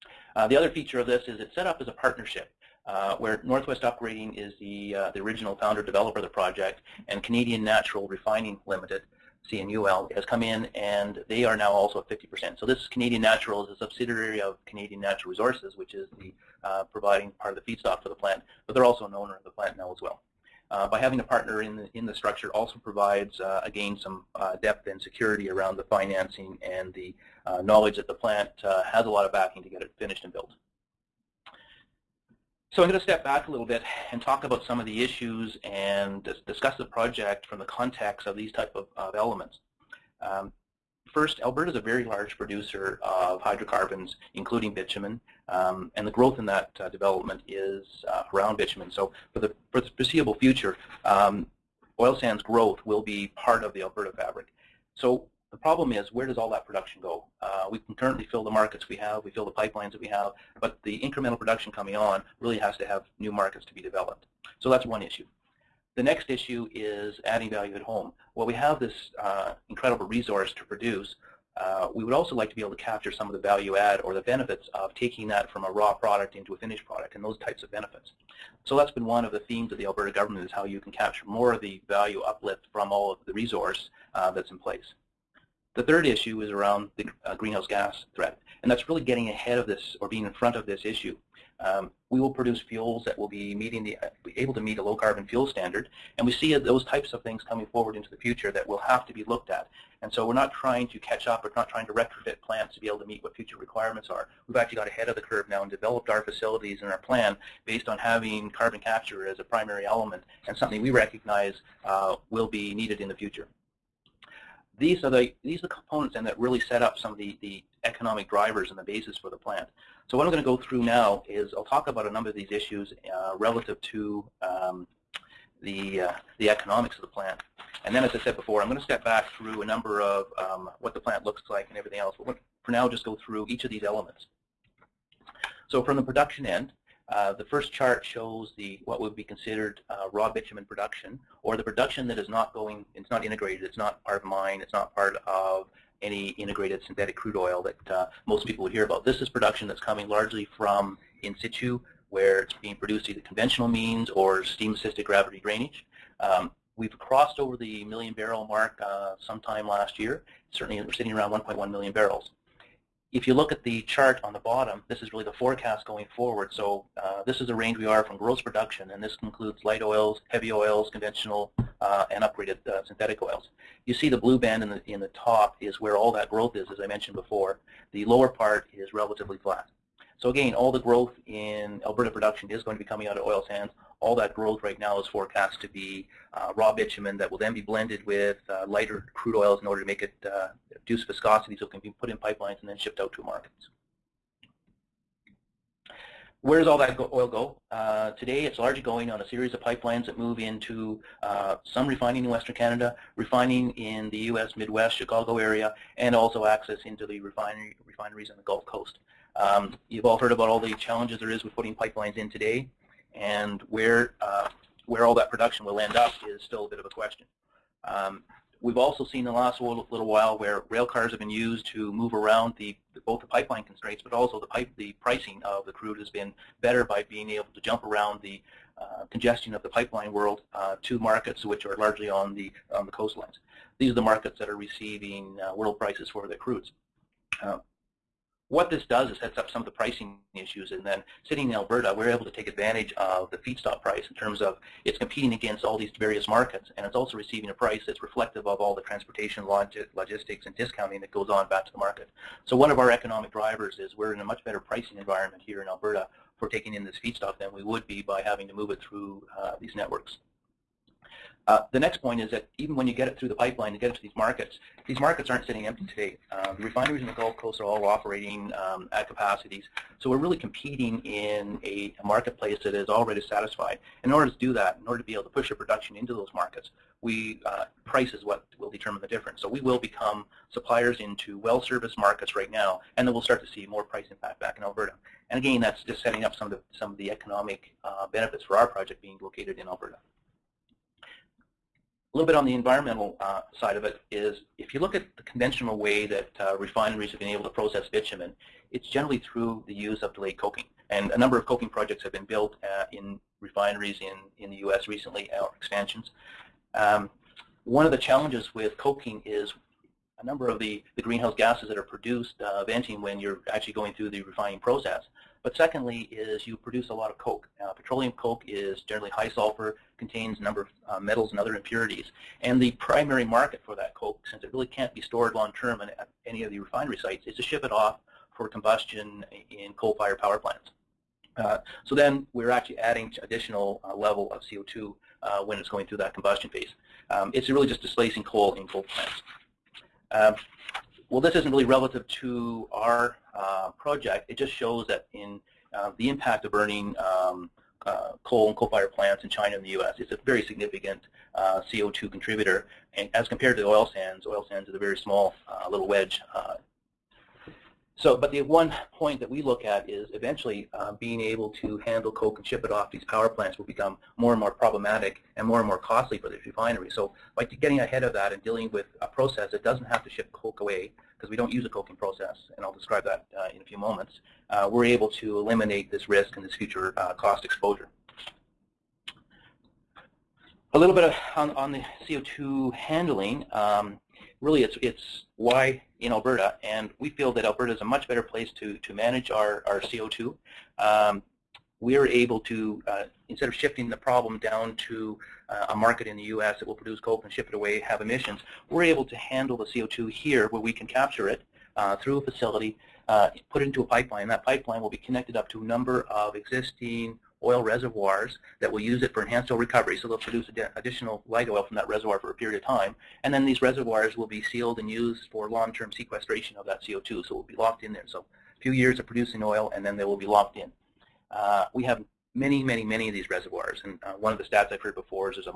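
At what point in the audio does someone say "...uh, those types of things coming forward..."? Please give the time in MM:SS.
01:36.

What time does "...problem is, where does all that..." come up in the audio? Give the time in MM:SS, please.
00:55.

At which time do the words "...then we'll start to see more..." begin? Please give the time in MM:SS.
04:43.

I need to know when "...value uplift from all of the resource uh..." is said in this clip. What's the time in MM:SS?
01:21.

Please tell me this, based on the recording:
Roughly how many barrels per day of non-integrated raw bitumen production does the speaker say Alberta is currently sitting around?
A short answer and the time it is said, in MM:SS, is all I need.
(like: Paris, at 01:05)
1.1 million barrels, at 02:41.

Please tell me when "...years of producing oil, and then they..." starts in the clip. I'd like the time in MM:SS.
06:58.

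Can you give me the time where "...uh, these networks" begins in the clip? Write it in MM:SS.
04:19.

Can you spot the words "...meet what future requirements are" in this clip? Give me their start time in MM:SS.
01:43.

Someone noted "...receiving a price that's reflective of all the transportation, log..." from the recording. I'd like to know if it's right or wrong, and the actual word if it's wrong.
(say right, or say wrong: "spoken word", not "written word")
right.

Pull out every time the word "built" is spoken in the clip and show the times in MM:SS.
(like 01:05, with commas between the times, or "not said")
00:30, 05:02.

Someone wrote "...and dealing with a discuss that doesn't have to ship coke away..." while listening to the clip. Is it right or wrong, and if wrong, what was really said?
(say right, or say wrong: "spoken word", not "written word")
wrong: "process", not "discuss".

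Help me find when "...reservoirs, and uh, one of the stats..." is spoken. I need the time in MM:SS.
07:03.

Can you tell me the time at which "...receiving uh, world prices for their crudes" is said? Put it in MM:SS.
03:54.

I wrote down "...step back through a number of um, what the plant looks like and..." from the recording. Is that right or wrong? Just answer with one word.
right.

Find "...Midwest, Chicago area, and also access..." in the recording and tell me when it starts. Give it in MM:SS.
03:24.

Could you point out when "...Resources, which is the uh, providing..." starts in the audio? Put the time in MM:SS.
00:15.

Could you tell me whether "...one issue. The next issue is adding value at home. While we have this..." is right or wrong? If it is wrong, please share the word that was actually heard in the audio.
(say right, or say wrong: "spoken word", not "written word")
right.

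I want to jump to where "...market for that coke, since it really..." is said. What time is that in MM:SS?
05:23.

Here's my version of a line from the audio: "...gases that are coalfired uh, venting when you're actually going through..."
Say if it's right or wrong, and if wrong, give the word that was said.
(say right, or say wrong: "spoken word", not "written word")
wrong: "produced", not "coalfired".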